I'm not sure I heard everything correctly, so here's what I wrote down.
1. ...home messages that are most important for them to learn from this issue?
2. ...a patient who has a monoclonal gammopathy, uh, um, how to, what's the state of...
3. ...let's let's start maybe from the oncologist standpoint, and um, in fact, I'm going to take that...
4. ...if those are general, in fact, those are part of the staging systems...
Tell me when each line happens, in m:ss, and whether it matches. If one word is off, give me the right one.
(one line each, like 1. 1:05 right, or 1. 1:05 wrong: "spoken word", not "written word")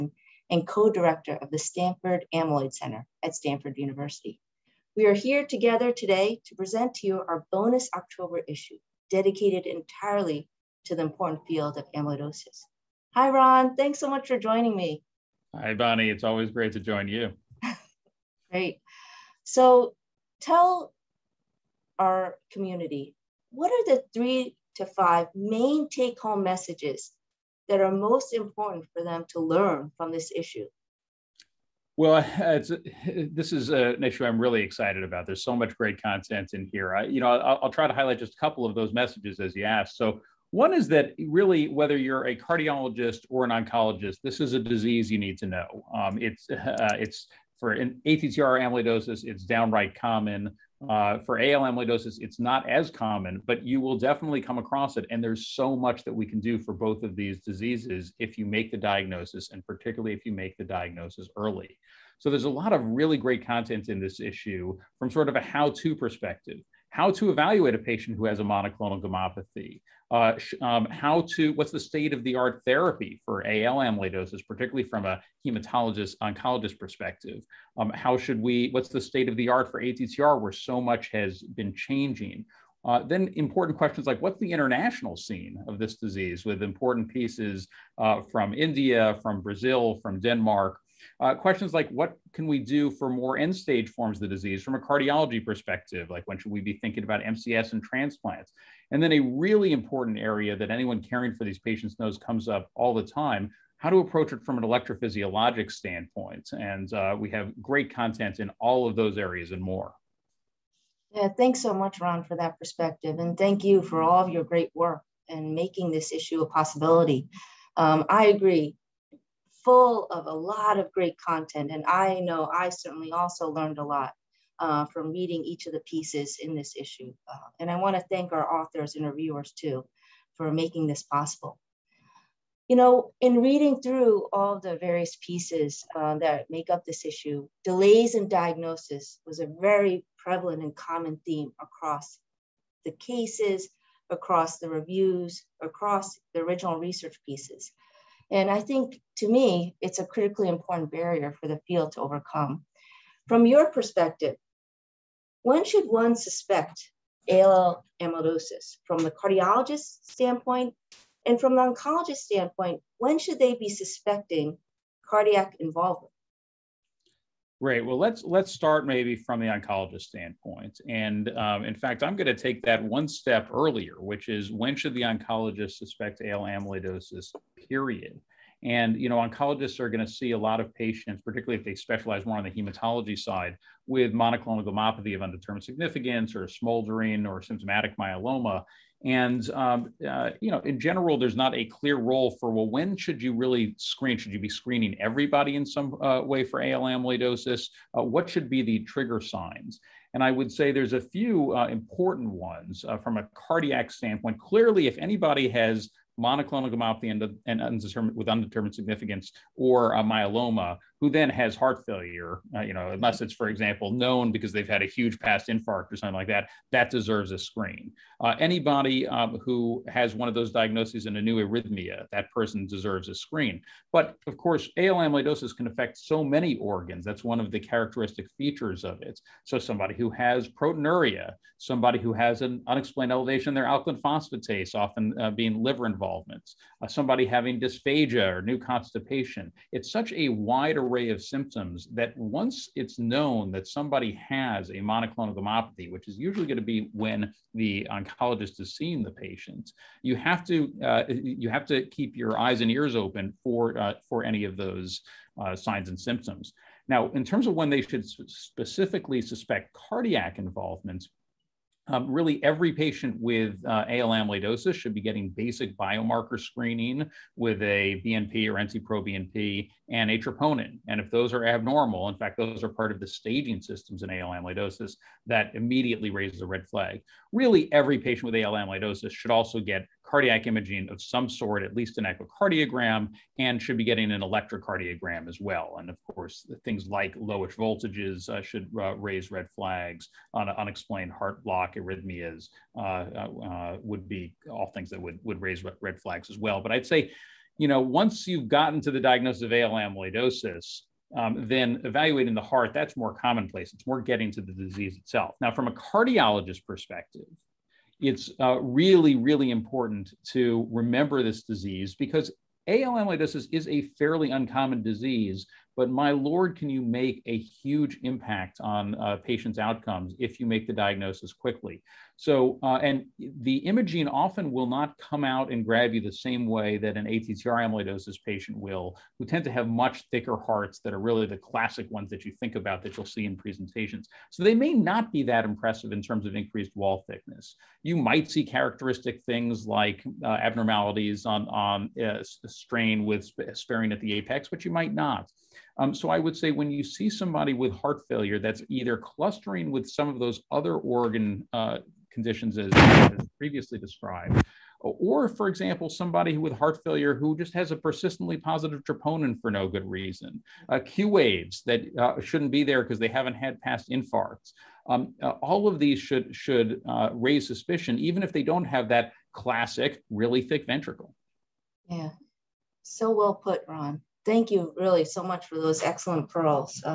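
1. 0:26 right
2. 1:07 right
3. 2:47 right
4. 4:30 wrong: "abnormal", not "general".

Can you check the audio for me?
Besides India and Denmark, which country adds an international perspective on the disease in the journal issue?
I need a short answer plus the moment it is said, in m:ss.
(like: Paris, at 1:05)
Brazil, at 1:29.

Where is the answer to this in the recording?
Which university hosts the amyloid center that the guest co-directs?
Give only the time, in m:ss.
0:03.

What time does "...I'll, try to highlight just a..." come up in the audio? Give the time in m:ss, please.
0:37.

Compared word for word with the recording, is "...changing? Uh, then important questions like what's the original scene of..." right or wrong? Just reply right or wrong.
wrong.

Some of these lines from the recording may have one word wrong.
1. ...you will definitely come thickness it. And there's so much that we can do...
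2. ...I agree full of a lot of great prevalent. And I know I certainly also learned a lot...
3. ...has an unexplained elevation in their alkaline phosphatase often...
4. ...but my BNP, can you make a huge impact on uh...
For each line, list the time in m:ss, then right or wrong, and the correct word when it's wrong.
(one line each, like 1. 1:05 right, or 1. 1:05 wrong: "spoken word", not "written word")
1. 0:53 wrong: "across", not "thickness"
2. 1:58 wrong: "content", not "prevalent"
3. 3:52 right
4. 5:15 wrong: "Lord", not "BNP".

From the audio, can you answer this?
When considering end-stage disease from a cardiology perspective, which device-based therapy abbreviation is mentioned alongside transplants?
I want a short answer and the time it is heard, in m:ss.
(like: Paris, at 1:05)
MCS, at 1:37.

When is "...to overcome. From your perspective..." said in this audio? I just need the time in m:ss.
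2:31.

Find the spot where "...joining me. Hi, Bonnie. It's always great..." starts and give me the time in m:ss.
0:14.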